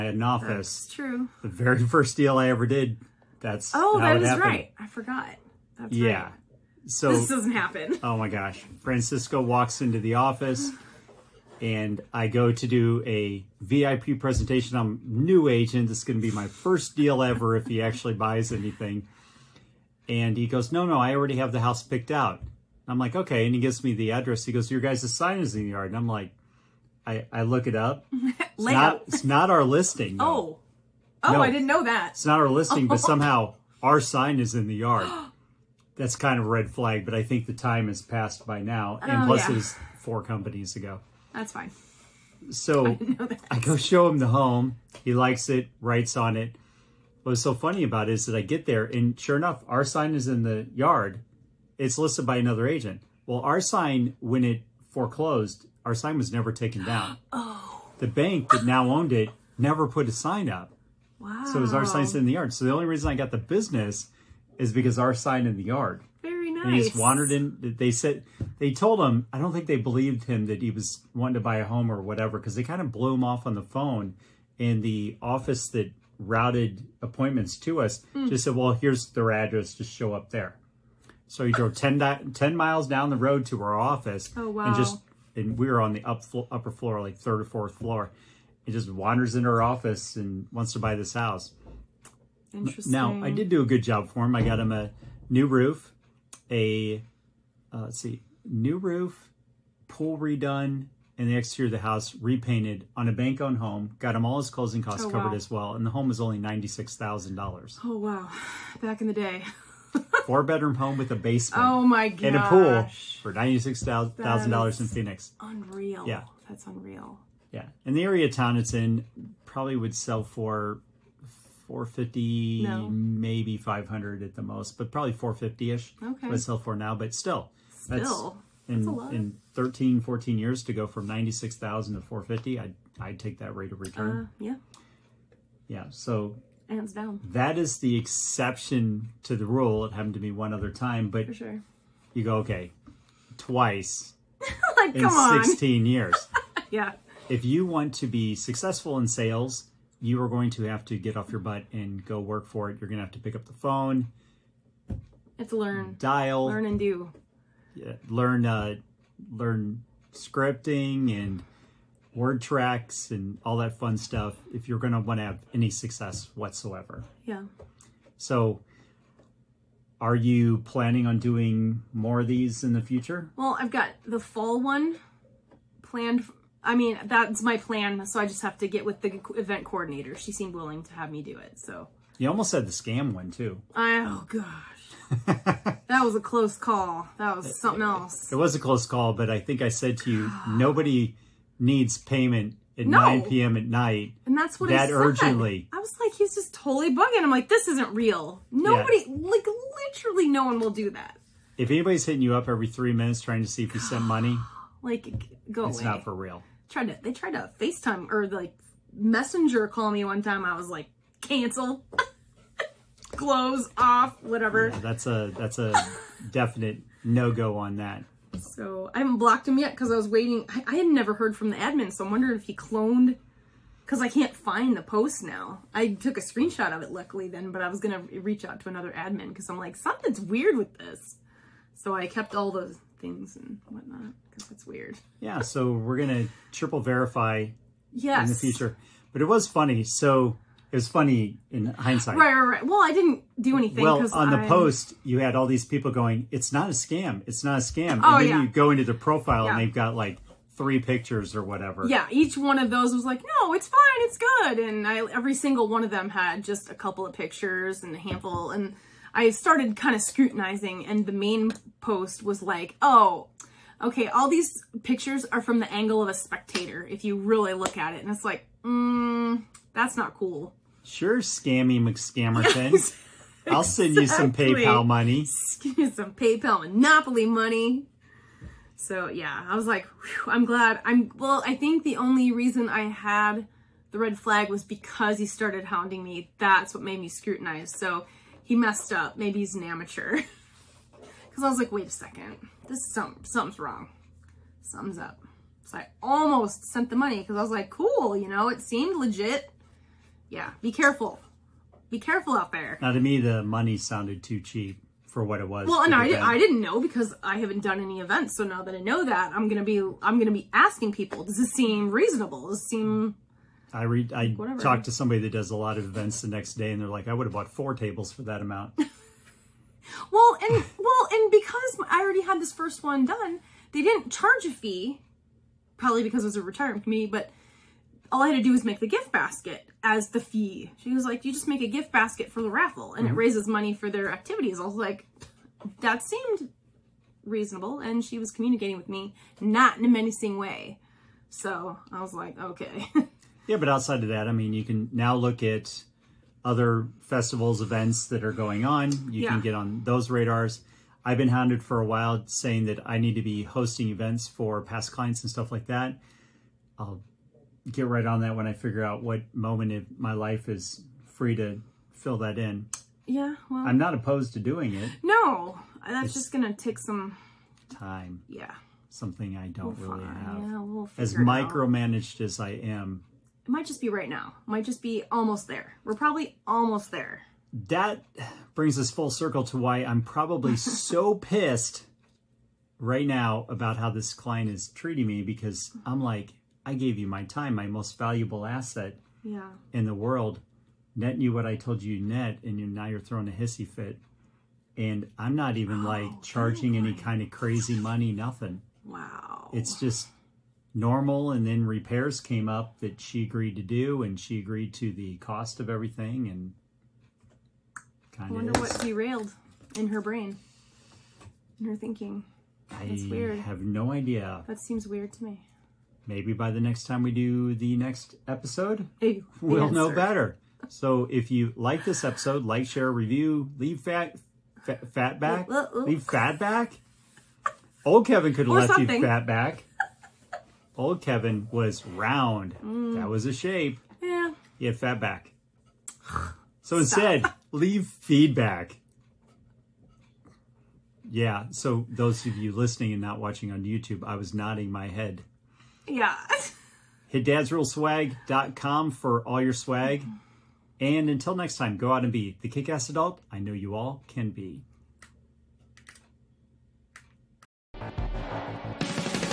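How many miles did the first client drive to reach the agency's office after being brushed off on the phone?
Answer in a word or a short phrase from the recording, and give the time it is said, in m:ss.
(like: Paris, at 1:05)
10, at 1:22.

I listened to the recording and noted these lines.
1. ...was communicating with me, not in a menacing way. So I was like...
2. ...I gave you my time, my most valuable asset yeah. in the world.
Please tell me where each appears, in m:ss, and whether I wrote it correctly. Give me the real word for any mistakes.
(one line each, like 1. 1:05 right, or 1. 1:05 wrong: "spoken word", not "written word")
1. 5:38 right
2. 6:26 right.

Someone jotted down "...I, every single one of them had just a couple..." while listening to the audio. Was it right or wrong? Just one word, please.
right.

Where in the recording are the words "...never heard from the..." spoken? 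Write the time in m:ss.
3:40.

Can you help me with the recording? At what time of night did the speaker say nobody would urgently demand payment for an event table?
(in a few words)
9 p.m.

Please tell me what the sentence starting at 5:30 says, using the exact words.
She was like, you just make a gift basket for the raffle and mm -hmm.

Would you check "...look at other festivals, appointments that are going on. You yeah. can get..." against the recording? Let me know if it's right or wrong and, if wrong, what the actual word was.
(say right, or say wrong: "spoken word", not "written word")
wrong: "events", not "appointments".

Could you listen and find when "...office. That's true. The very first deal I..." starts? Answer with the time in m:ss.
0:00.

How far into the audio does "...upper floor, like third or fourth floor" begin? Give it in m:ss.
1:26.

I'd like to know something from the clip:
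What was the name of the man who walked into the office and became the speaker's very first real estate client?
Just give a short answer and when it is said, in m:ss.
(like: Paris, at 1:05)
Francisco, at 0:08.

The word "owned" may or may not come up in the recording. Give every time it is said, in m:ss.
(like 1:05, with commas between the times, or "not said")
0:58, 1:43.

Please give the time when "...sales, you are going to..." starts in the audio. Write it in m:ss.
2:29.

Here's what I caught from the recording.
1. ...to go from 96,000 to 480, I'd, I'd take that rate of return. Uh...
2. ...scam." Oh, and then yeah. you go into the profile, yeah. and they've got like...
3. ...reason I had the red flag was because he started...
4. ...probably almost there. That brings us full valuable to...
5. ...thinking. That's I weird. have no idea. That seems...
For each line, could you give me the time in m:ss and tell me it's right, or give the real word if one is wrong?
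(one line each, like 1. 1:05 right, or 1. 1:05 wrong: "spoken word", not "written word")
1. 2:10 wrong: "450", not "480"
2. 4:07 right
3. 4:42 right
4. 6:15 wrong: "circle", not "valuable"
5. 6:51 right.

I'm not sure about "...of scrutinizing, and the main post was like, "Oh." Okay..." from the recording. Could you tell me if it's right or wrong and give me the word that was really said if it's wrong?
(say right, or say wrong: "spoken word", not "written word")
right.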